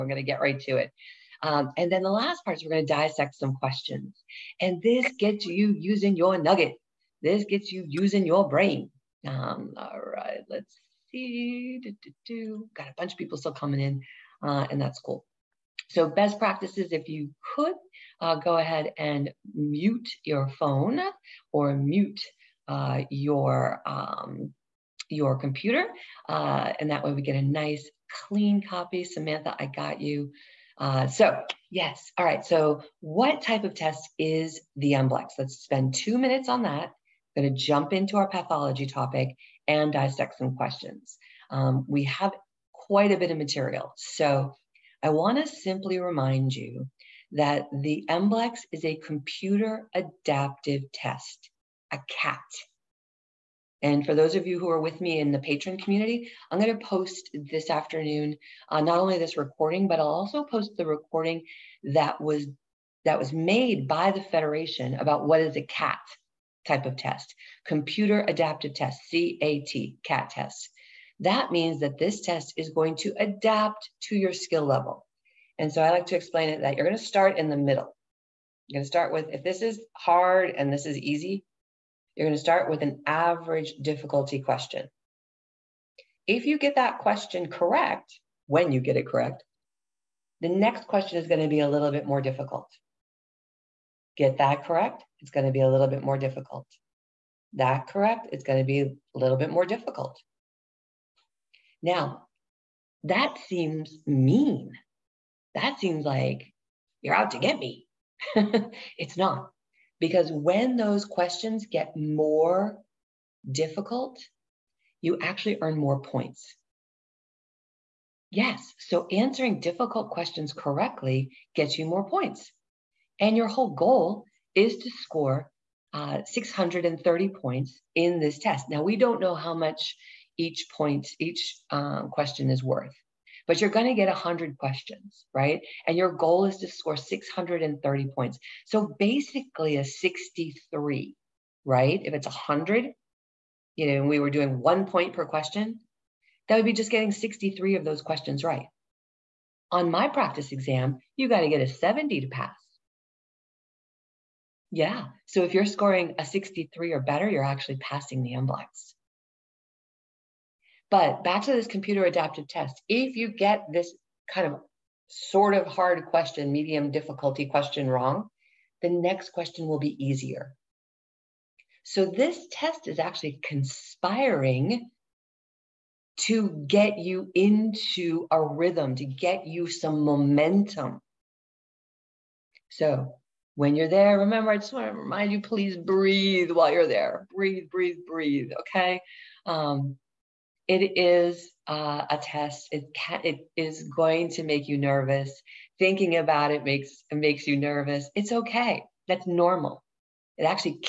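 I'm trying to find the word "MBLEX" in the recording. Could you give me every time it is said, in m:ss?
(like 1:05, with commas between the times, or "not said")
0:34, 0:48, 2:38.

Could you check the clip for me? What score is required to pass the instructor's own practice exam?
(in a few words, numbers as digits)
70.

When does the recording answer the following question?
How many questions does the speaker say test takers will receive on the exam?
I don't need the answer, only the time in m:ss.
2:14.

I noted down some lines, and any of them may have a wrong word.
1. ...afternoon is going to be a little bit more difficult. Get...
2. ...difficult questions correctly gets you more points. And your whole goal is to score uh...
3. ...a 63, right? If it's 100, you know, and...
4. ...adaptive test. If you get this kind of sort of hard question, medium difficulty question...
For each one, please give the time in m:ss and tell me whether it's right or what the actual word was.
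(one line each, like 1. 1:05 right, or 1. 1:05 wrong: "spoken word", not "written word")
1. 1:30 wrong: "question", not "afternoon"
2. 1:59 right
3. 2:19 right
4. 2:42 right.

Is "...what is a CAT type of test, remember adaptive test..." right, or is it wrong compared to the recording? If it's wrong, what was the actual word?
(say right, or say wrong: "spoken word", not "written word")
wrong: "computer", not "remember".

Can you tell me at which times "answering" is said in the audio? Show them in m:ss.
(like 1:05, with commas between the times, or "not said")
1:59.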